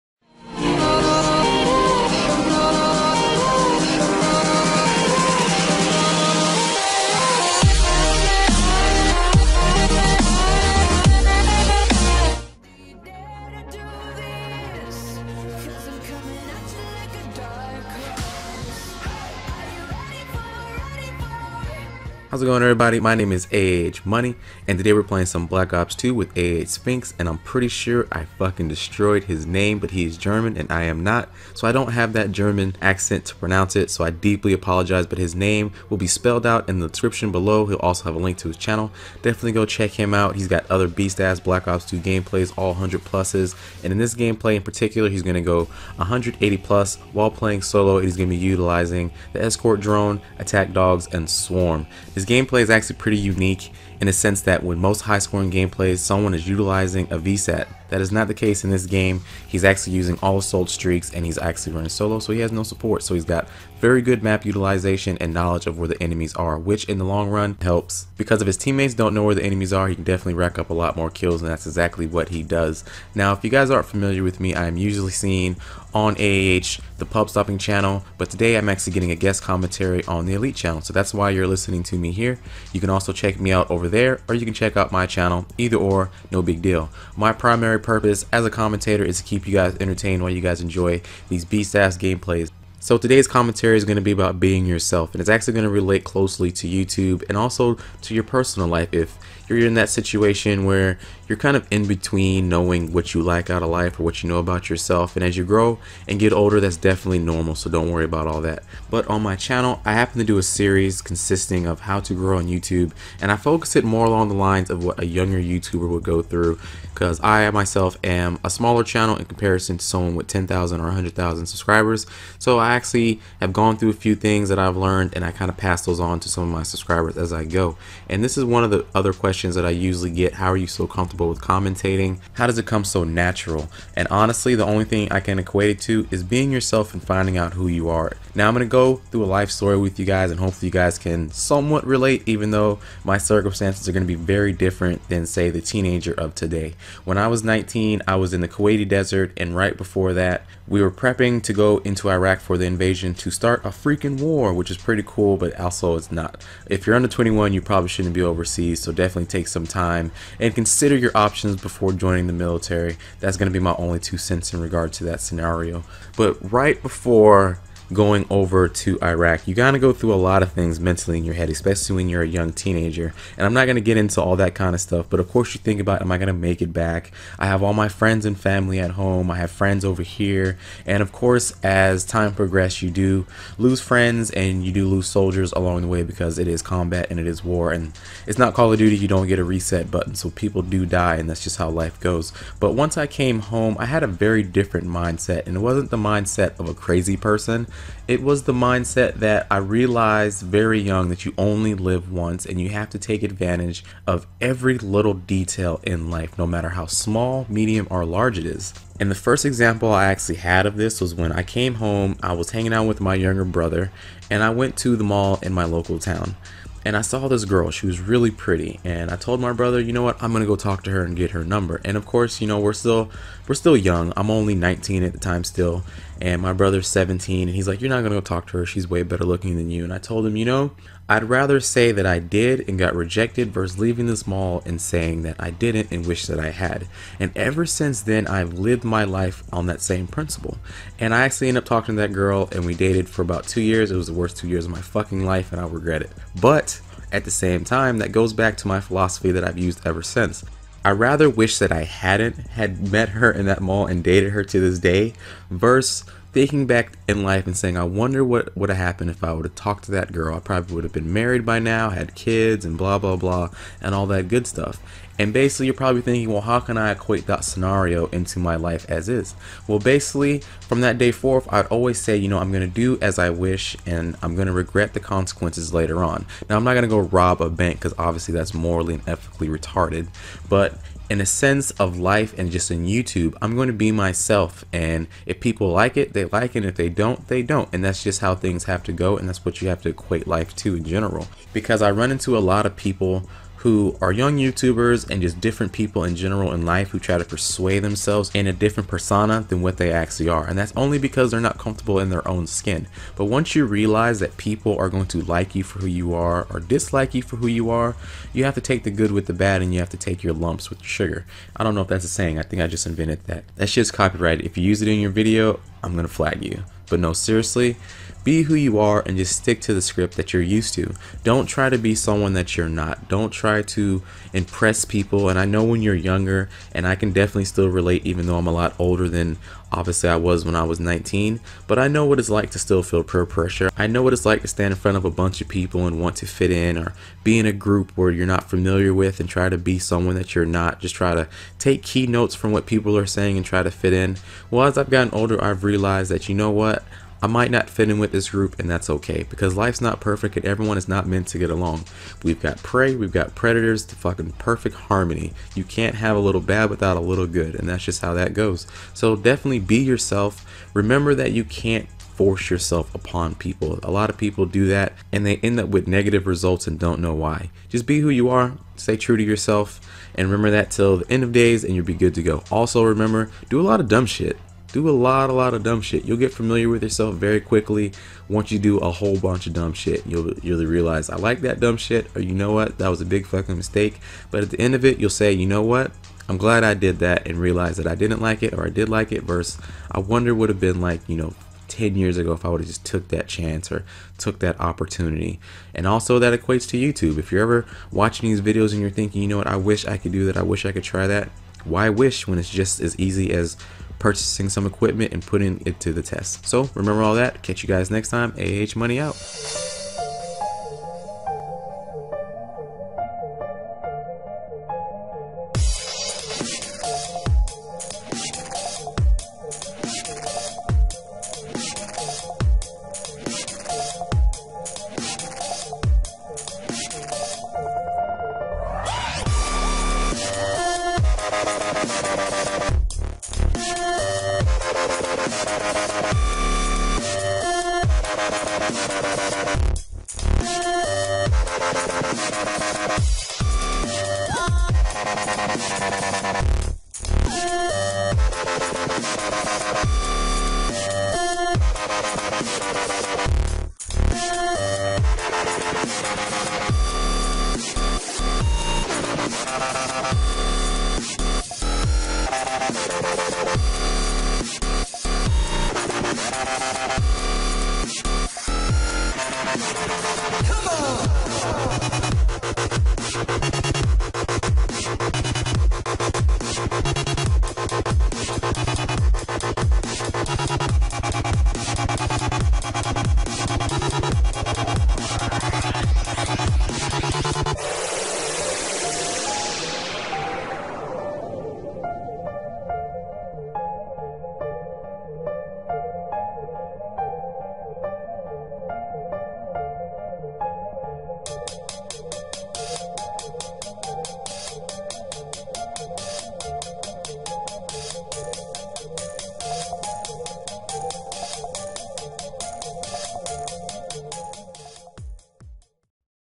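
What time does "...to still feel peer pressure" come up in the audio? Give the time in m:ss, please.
5:32.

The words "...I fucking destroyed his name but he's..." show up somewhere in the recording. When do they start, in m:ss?
0:28.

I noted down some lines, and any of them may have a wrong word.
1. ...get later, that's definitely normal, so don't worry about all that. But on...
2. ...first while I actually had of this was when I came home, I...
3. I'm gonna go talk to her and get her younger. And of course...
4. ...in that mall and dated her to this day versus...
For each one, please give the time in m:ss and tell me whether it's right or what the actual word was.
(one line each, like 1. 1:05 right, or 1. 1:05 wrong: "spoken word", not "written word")
1. 1:46 wrong: "older", not "later"
2. 3:29 wrong: "example", not "while"
3. 3:40 wrong: "number", not "younger"
4. 4:13 right.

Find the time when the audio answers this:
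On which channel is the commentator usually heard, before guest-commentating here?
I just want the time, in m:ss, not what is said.
1:17.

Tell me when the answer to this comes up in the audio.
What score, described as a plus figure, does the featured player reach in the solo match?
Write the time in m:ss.
0:45.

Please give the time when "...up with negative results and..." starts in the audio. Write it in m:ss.
6:05.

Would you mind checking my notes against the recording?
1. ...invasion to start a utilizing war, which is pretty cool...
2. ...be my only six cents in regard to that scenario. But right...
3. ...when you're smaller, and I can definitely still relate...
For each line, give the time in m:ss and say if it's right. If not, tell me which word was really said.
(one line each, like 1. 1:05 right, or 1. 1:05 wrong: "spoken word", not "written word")
1. 2:32 wrong: "freaking", not "utilizing"
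2. 2:43 wrong: "two", not "six"
3. 5:25 wrong: "younger", not "smaller".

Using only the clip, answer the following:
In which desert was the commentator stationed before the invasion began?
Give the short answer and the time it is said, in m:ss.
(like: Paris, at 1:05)
Kuwaiti desert, at 2:28.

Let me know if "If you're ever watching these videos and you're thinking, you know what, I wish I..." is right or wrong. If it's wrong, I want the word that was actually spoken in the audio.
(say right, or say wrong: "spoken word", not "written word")
right.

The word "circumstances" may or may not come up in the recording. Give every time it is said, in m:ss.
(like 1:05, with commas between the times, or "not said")
2:23.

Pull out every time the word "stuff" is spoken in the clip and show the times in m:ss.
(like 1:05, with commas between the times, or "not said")
2:54, 4:24.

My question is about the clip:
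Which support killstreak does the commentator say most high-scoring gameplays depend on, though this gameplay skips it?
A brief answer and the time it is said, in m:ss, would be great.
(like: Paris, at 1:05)
VSAT, at 0:57.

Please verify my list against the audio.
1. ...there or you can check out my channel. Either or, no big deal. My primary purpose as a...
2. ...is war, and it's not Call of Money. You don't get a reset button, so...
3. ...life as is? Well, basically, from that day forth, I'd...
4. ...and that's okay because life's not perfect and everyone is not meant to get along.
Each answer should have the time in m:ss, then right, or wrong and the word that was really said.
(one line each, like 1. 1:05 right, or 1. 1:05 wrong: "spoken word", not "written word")
1. 1:23 right
2. 3:07 wrong: "Duty", not "Money"
3. 4:28 right
4. 5:48 right.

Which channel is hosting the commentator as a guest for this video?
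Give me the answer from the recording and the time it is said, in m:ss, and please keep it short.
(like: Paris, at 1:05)
Elite channel, at 1:20.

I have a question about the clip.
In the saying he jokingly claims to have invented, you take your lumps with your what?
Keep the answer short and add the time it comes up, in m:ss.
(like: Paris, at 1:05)
sugar, at 5:10.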